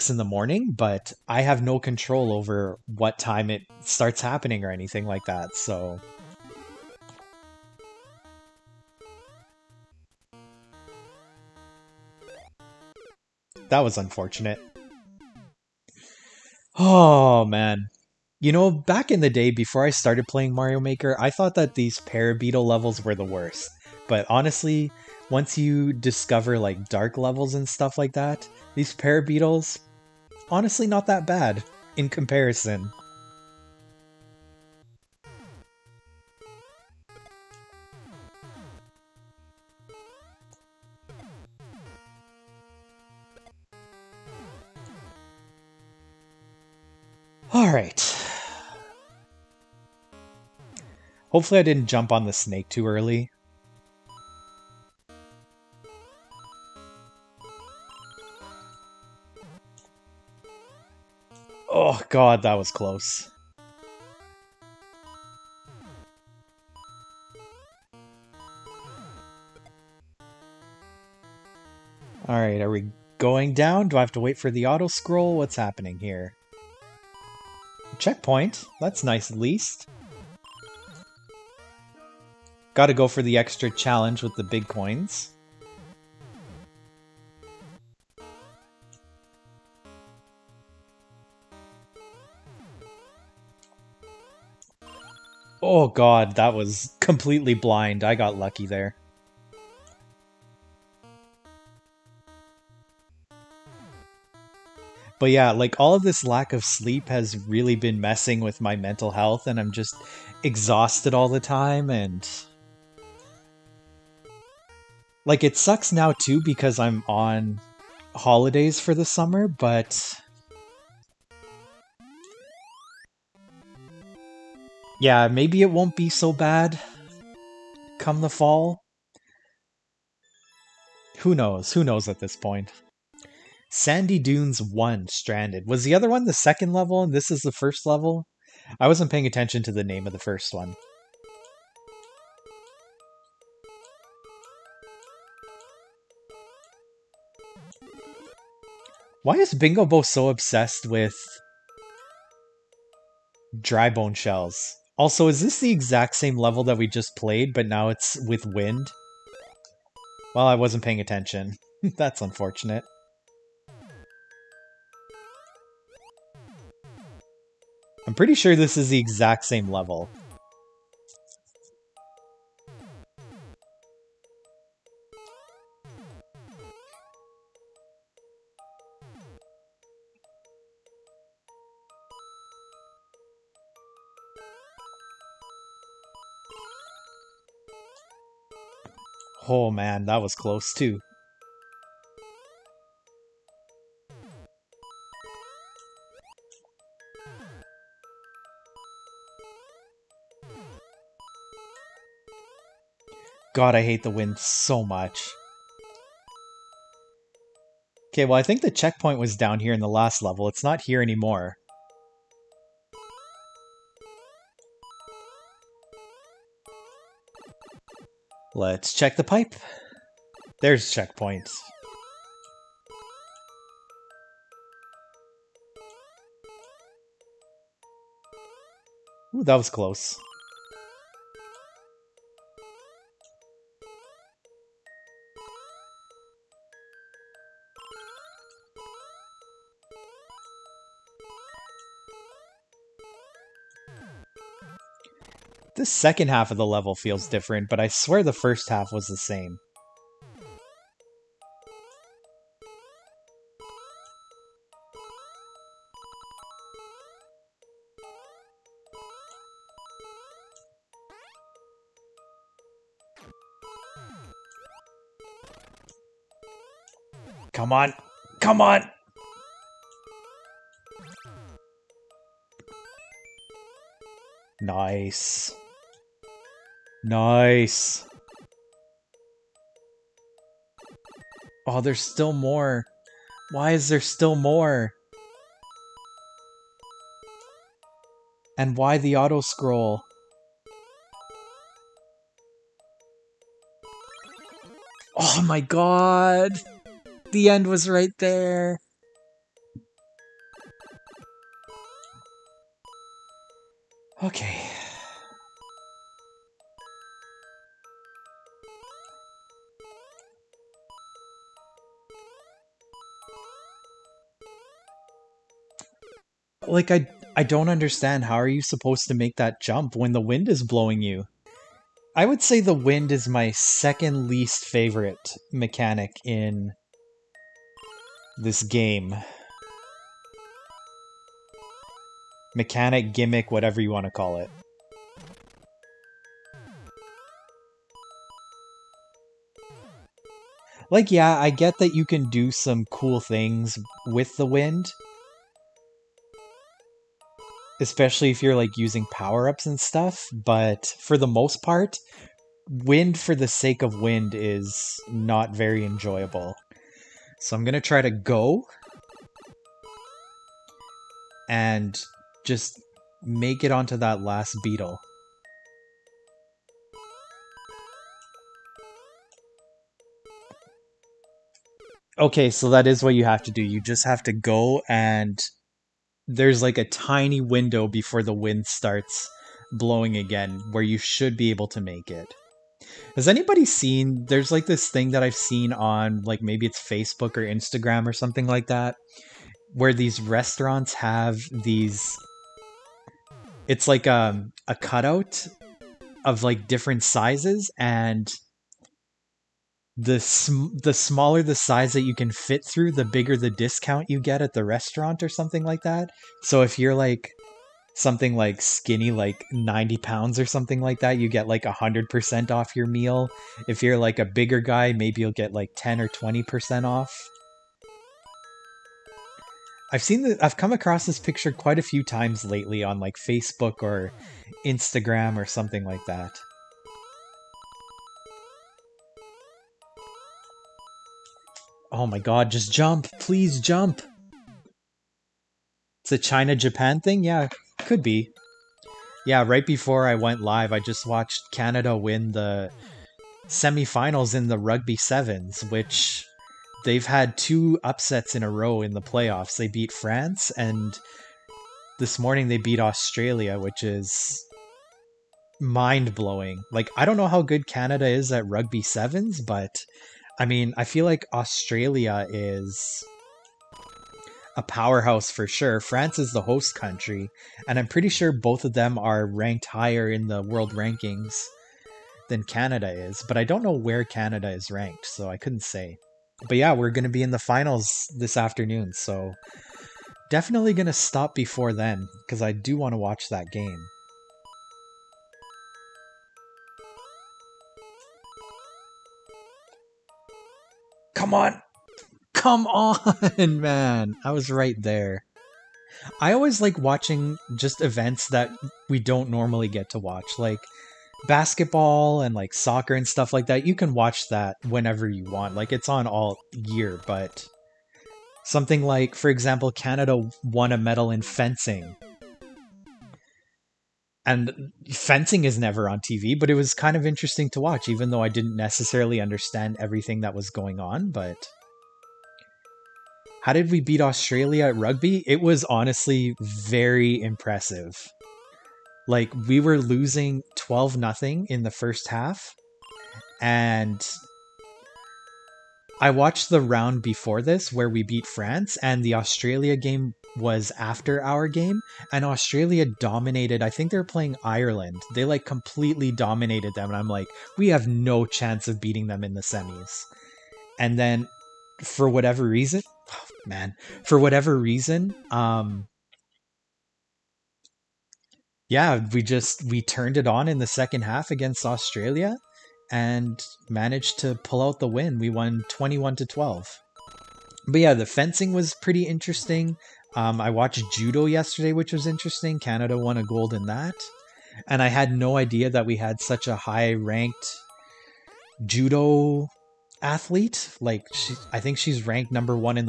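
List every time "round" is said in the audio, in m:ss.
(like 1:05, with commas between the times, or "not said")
8:56.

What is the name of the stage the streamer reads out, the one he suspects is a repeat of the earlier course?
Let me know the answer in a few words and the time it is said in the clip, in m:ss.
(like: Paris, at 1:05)
Sandy Dunes 1 Stranded, at 2:13.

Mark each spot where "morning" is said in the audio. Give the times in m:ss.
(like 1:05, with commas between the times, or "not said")
0:00, 7:32.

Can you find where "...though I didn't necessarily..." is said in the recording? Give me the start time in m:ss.
8:38.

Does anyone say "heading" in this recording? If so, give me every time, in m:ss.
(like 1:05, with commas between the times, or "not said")
not said.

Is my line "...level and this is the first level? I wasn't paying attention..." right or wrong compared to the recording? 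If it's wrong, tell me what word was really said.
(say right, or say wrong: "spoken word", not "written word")
right.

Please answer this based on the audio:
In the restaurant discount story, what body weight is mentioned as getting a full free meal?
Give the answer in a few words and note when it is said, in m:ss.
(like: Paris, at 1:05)
90 pounds, at 6:49.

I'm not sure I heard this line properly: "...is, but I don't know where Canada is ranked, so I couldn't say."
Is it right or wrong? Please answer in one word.
right.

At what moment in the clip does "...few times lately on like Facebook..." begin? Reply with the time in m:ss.
7:01.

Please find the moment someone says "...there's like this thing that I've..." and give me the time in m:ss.
6:24.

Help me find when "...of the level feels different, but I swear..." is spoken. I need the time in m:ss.
4:06.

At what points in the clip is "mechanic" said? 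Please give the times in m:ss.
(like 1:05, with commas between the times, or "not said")
5:25, 5:32.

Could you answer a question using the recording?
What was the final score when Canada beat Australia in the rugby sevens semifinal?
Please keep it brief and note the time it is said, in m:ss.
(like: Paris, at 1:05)
21 to 12, at 9:25.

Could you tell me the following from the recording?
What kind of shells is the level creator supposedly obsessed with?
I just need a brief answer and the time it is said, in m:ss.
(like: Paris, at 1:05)
dry bone shells, at 2:33.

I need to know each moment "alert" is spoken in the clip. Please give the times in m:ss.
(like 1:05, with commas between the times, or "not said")
not said.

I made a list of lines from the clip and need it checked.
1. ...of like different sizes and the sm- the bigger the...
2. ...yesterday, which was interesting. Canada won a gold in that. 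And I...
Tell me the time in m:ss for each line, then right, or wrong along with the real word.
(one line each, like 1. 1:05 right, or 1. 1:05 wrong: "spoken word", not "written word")
1. 6:36 wrong: "smaller", not "bigger"
2. 9:31 right.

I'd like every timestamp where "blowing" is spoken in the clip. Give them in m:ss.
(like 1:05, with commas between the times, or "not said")
5:20, 6:19, 7:36.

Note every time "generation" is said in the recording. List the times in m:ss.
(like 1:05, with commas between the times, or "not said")
not said.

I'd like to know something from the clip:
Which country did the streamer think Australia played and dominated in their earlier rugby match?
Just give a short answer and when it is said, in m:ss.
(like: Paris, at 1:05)
Ireland, at 9:04.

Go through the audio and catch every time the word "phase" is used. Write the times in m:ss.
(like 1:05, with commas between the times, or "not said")
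not said.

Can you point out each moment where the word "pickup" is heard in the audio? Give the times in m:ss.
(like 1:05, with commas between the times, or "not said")
not said.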